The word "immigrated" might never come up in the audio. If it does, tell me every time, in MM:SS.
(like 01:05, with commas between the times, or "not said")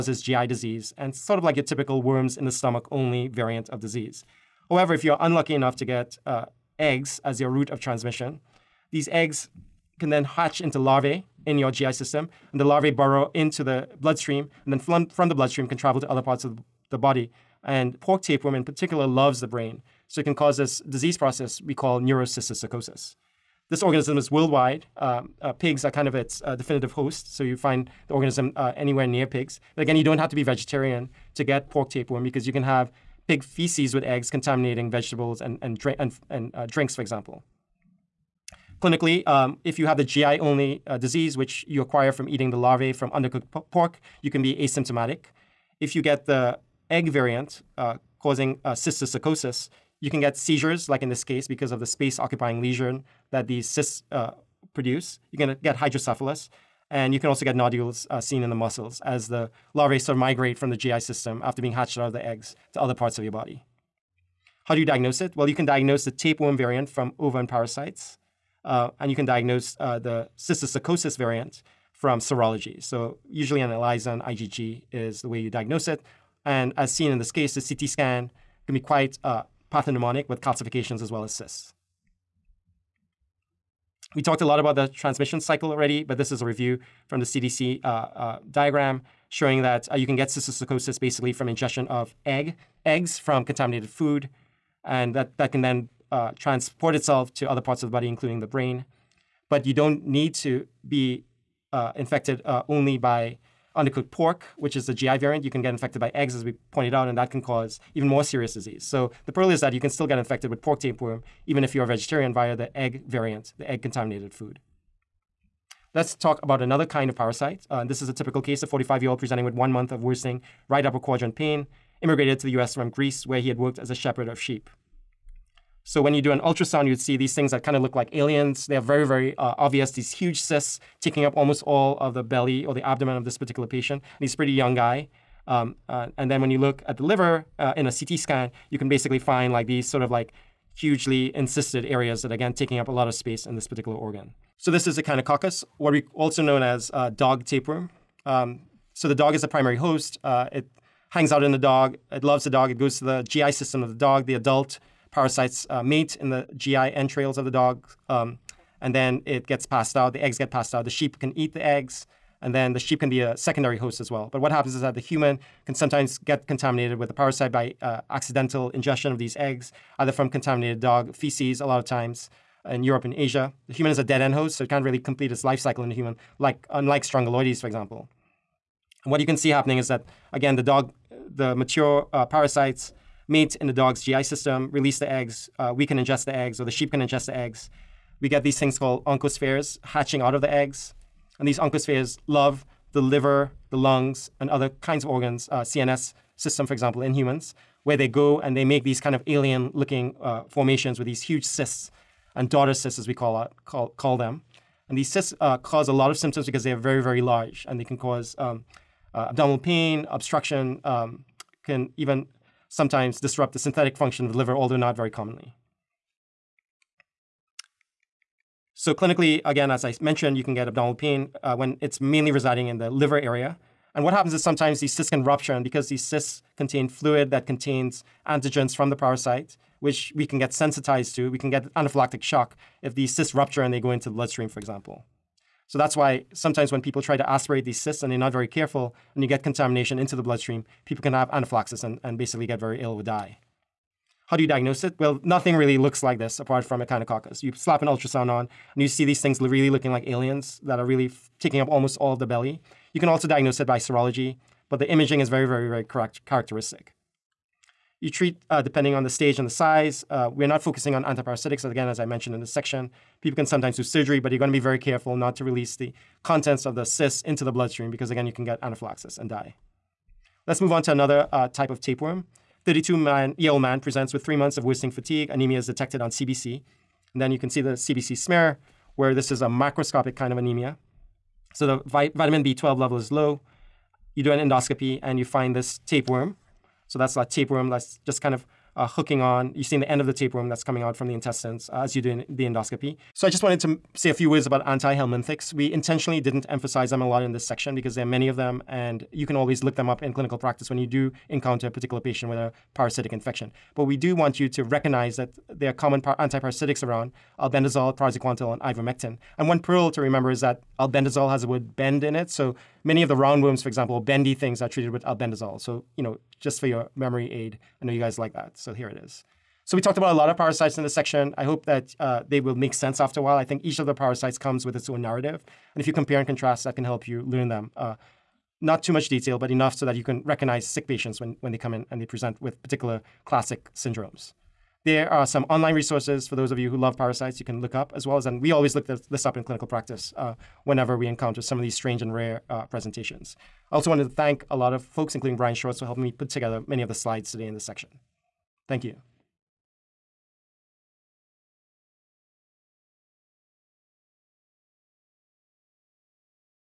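02:02.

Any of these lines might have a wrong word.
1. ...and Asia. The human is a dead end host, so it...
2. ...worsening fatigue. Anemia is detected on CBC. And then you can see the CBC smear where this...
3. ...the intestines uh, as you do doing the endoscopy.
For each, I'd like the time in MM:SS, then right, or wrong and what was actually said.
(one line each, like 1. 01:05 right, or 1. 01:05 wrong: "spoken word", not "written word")
1. 02:53 right
2. 04:34 right
3. 04:51 right.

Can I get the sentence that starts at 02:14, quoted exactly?
And he's a pretty young guy.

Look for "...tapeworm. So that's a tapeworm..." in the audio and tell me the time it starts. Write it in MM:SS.
04:45.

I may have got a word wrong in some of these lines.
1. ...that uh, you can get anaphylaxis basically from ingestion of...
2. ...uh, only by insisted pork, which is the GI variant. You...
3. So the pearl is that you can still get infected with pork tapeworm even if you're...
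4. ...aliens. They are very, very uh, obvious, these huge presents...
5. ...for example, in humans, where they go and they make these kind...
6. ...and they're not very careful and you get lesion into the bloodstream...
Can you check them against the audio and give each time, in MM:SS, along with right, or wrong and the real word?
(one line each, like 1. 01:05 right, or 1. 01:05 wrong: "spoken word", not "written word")
1. 01:29 wrong: "cysticercosis", not "anaphylaxis"
2. 01:42 wrong: "undercooked", not "insisted"
3. 01:48 right
4. 02:08 wrong: "cysts", not "presents"
5. 03:16 right
6. 03:58 wrong: "contamination", not "lesion".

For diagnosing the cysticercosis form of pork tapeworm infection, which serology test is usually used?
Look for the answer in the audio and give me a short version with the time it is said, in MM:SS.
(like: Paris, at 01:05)
ELISA, at 01:13.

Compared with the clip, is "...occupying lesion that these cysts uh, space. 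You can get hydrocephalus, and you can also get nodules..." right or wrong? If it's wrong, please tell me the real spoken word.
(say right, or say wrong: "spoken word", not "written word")
wrong: "produce", not "space".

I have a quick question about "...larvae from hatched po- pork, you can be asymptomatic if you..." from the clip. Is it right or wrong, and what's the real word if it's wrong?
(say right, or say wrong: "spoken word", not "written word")
wrong: "undercooked", not "hatched".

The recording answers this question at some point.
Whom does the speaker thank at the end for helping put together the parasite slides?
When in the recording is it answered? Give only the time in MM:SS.
05:45.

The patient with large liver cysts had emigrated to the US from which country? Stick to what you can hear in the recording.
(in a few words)
Greece.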